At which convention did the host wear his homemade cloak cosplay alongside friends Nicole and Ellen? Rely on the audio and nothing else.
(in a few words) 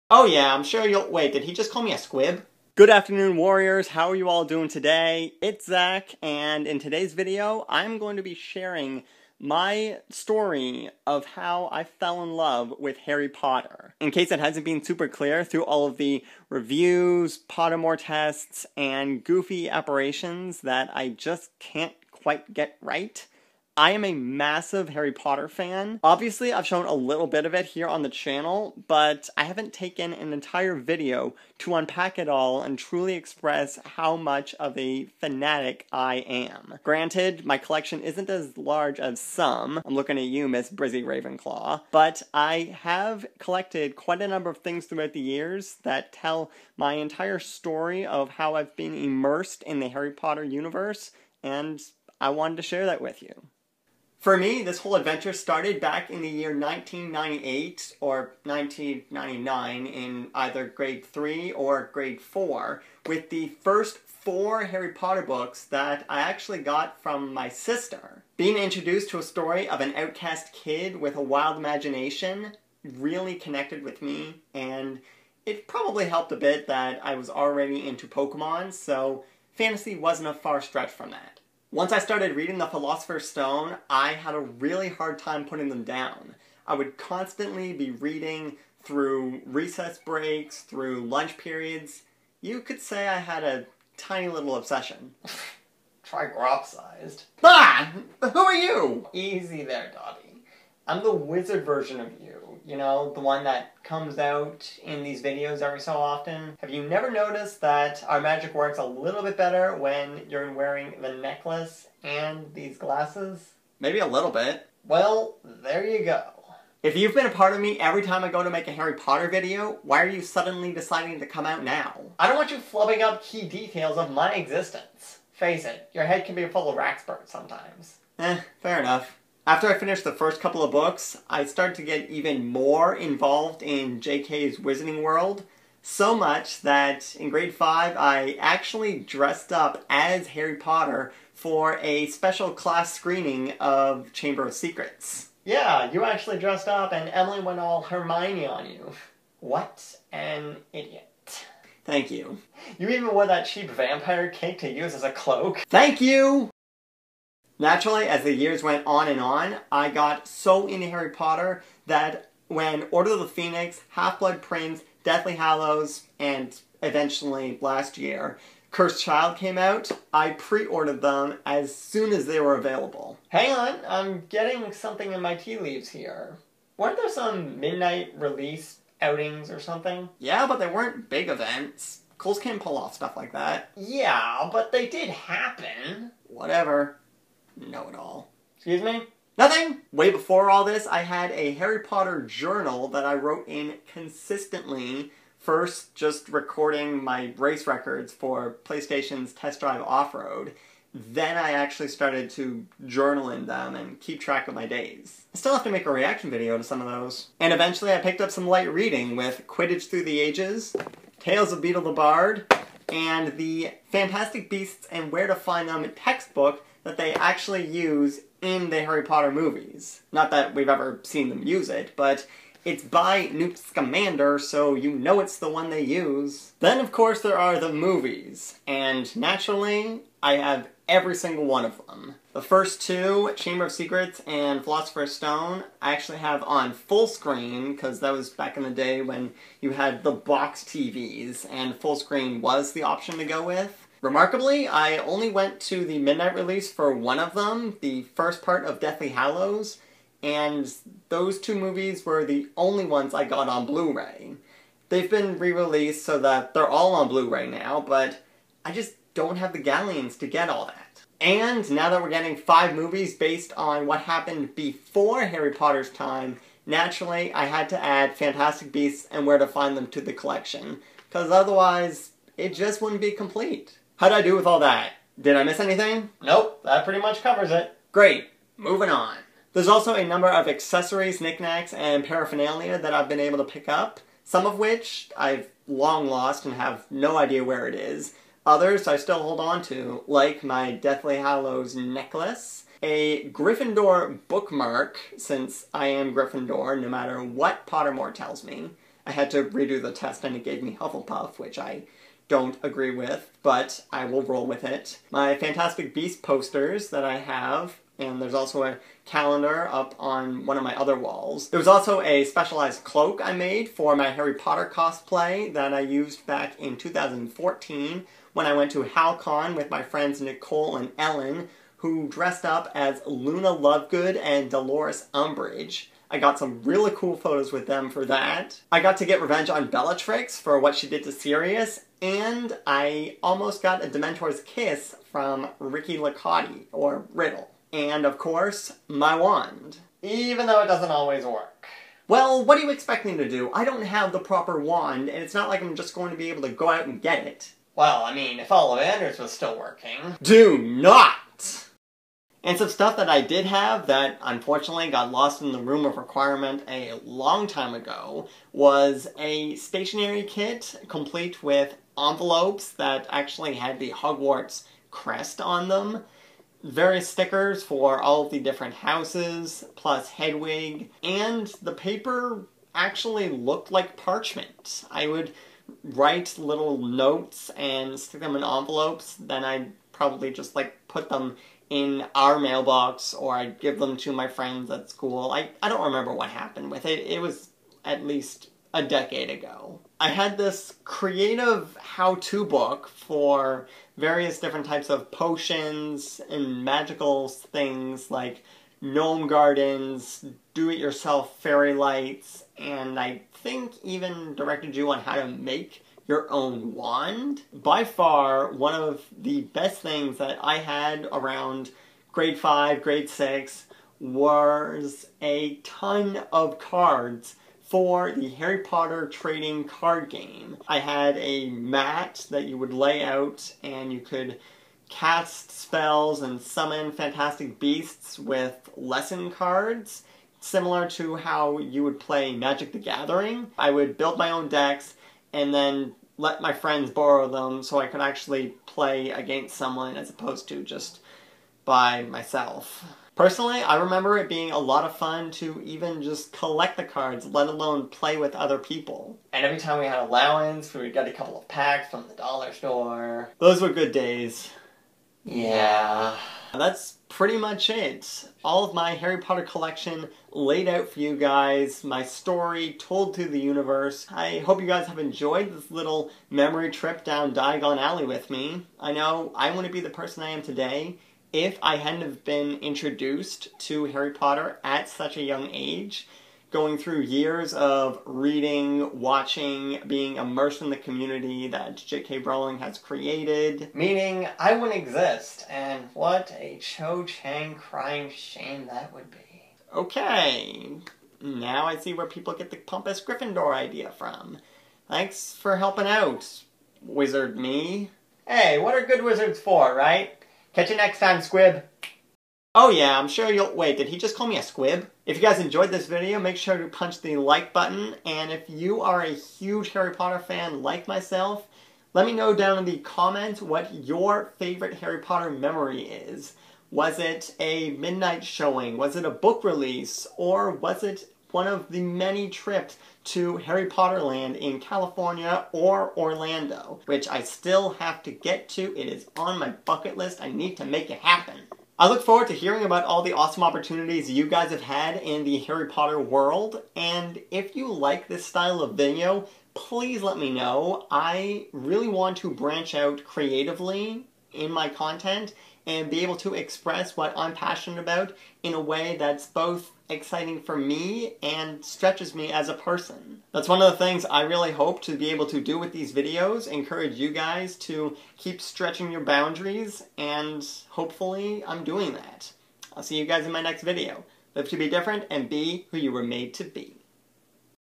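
Hal-Con.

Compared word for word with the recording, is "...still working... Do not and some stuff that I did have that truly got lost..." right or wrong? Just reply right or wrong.
wrong.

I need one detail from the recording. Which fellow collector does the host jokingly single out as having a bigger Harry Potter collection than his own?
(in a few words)
Brizzy Ravenclaw.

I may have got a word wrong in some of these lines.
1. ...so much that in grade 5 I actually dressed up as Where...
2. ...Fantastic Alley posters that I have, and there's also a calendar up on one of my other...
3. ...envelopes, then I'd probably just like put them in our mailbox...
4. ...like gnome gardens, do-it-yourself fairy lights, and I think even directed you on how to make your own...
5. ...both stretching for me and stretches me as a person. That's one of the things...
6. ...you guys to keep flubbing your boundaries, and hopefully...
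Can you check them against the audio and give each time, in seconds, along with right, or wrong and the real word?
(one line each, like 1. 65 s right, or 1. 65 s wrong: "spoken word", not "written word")
1. 135 s wrong: "Harry", not "Where"
2. 305 s wrong: "Beast", not "Alley"
3. 378 s right
4. 398 s right
5. 549 s wrong: "exciting", not "stretching"
6. 556 s wrong: "stretching", not "flubbing".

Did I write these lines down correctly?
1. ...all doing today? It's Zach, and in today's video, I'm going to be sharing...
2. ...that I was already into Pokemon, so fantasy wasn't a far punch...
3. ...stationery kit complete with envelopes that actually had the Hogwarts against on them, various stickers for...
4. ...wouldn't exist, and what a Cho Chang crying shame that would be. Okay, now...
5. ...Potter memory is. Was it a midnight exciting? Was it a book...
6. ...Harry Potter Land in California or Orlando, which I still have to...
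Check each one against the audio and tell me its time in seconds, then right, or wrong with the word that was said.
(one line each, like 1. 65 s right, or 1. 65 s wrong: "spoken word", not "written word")
1. 4 s right
2. 76 s wrong: "stretch", not "punch"
3. 359 s wrong: "crest", not "against"
4. 484 s right
5. 514 s wrong: "showing", not "exciting"
6. 523 s right.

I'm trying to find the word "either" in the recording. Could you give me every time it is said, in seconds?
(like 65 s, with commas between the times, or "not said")
60 s.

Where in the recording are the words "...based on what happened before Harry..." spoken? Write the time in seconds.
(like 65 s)
263 s.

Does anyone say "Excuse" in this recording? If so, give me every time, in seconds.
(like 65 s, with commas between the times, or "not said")
188 s.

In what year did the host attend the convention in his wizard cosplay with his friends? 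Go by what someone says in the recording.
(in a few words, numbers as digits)
2014.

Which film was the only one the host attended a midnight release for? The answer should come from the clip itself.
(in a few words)
Deathly Hallows Part 1.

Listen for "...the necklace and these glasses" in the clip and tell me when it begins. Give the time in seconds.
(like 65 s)
111 s.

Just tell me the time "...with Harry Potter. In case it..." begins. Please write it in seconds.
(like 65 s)
12 s.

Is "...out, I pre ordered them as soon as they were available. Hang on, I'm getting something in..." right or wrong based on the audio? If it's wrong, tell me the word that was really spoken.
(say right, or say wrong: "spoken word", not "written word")
right.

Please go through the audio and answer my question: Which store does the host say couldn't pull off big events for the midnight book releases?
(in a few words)
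Coles.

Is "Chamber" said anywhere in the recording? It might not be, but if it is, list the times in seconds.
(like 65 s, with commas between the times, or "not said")
144 s, 233 s.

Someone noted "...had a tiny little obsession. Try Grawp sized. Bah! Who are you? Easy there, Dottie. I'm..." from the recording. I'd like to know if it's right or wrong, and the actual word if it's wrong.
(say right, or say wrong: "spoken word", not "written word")
right.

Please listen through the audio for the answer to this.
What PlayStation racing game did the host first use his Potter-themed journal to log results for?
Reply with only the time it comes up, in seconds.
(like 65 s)
199 s.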